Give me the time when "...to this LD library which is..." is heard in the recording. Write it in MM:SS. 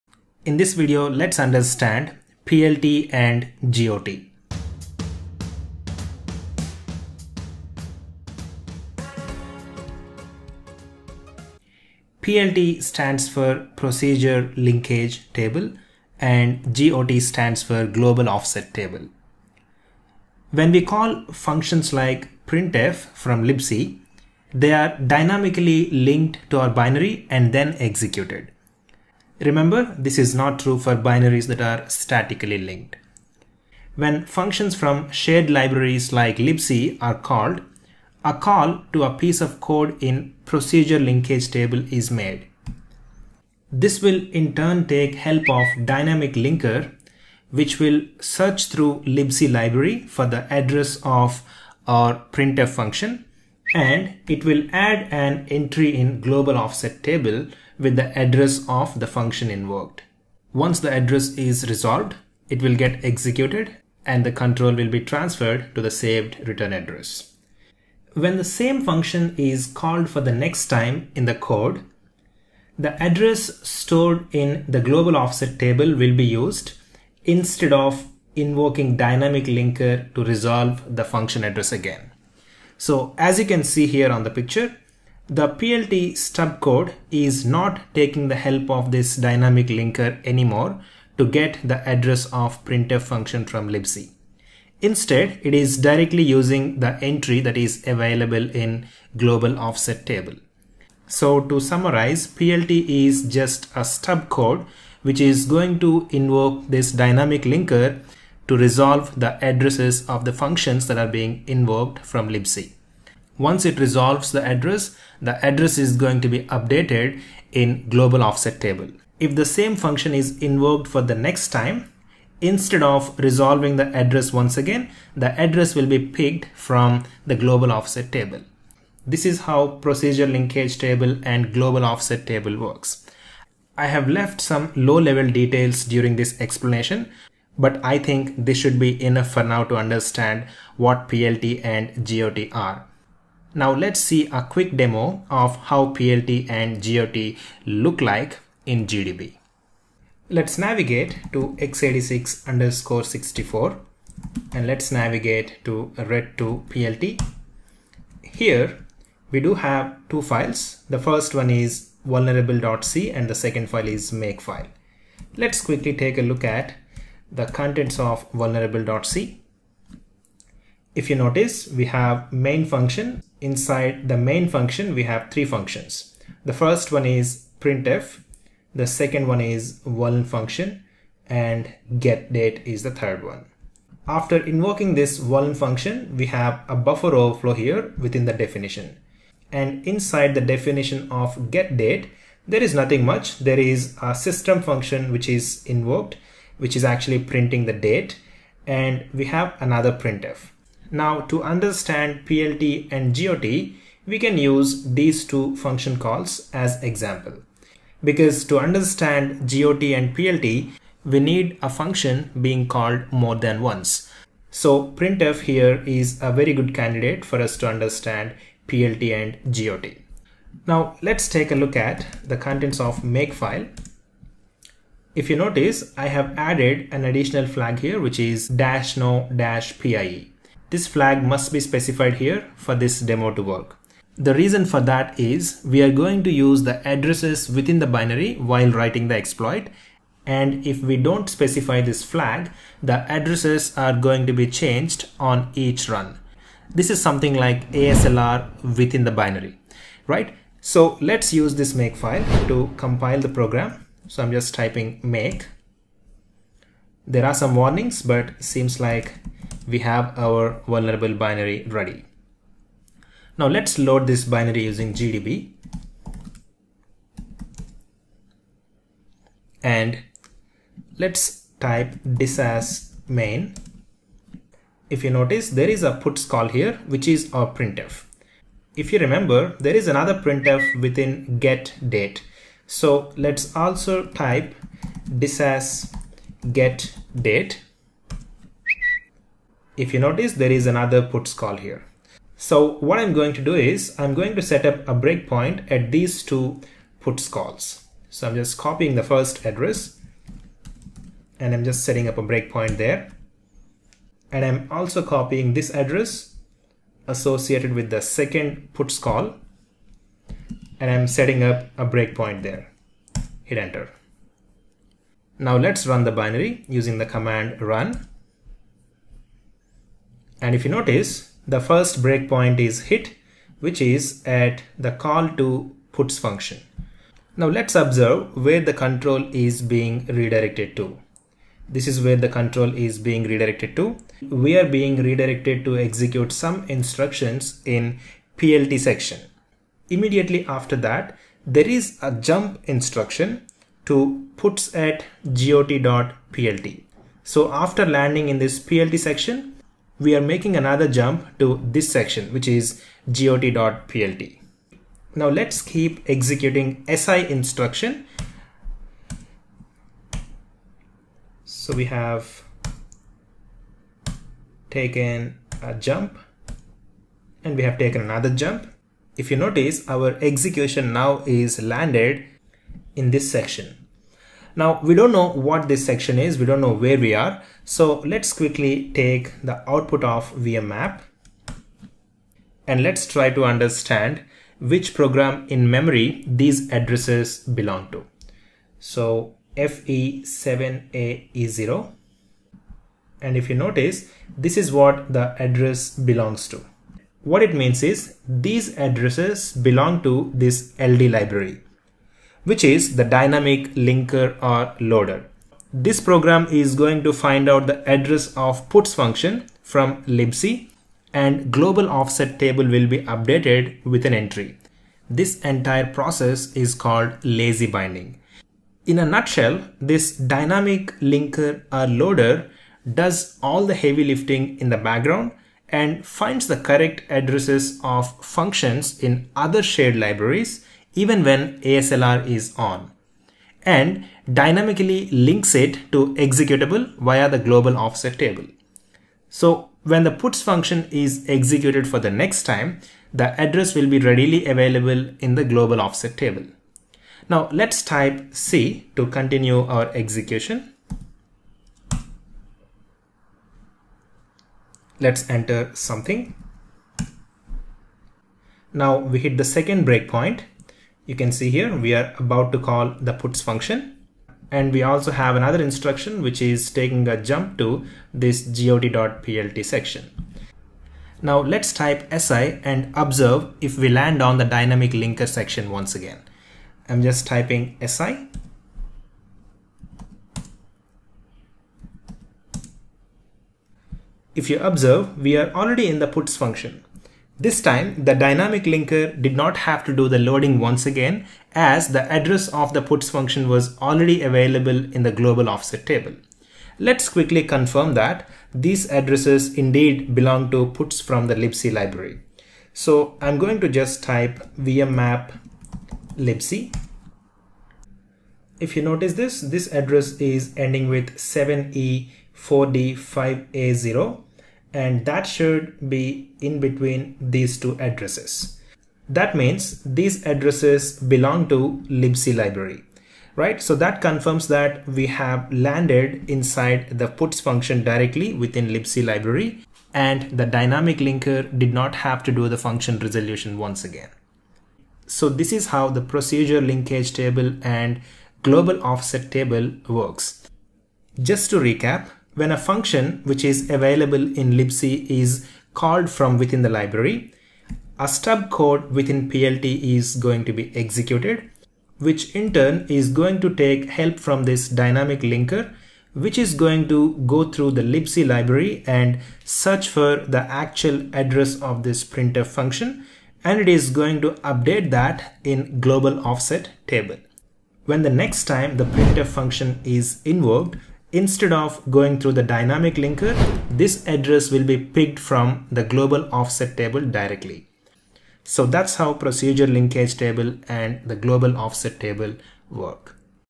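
06:40.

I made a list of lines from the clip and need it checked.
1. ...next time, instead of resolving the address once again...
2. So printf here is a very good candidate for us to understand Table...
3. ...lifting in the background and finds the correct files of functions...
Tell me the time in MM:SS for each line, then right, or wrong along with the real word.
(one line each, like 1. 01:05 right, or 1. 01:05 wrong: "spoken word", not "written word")
1. 02:01 right
2. 03:34 wrong: "PLT", not "Table"
3. 07:04 wrong: "addresses", not "files".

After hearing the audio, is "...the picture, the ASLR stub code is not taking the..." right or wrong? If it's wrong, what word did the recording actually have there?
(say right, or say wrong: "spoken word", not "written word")
wrong: "PLT", not "ASLR".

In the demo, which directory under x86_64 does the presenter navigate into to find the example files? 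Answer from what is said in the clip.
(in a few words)
ret2 PLT.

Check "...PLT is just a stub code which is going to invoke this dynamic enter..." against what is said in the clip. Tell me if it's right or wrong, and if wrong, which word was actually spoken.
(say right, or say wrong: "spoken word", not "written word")
wrong: "linker", not "enter".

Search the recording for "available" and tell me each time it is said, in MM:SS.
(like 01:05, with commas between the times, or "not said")
01:37, 07:24, 08:14, 09:03.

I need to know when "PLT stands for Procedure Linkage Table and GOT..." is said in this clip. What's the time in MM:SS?
00:12.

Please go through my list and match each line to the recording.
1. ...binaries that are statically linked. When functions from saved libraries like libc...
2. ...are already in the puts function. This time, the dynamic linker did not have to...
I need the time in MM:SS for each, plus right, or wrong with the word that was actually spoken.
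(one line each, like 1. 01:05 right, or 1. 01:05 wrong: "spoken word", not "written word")
1. 00:30 wrong: "shared", not "saved"
2. 08:05 right.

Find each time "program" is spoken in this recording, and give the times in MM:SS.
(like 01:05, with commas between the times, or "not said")
04:13, 06:24, 06:46.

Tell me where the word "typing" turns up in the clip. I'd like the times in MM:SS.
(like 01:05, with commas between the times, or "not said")
04:14, 07:57.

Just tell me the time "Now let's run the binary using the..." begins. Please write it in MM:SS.
05:15.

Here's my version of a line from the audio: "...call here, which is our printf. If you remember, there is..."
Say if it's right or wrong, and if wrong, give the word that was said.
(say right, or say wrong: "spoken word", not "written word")
right.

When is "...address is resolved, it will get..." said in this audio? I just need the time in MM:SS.
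01:00.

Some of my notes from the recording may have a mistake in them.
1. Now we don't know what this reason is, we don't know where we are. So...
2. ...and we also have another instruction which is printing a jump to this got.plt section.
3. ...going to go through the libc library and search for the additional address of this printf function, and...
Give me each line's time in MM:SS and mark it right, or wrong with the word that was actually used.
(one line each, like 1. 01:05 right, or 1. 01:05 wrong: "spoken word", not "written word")
1. 06:14 wrong: "section", not "reason"
2. 07:44 wrong: "taking", not "printing"
3. 09:16 wrong: "actual", not "additional".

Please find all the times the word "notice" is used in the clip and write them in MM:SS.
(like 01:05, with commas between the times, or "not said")
02:51, 03:45, 04:35, 04:49, 05:20, 06:09, 06:33, 08:28.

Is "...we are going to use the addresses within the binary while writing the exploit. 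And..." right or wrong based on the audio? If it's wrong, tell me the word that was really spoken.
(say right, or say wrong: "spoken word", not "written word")
right.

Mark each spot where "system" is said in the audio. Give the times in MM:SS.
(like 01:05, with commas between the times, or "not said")
03:14.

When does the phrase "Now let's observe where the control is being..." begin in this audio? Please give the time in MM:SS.
05:27.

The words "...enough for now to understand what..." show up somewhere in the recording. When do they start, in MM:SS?
02:19.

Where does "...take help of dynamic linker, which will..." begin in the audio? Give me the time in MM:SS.
00:44.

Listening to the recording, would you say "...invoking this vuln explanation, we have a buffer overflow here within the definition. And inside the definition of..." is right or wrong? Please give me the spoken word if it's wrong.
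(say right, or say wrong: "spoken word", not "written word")
wrong: "function", not "explanation".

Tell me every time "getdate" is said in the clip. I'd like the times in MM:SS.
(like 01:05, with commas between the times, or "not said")
03:01, 03:11.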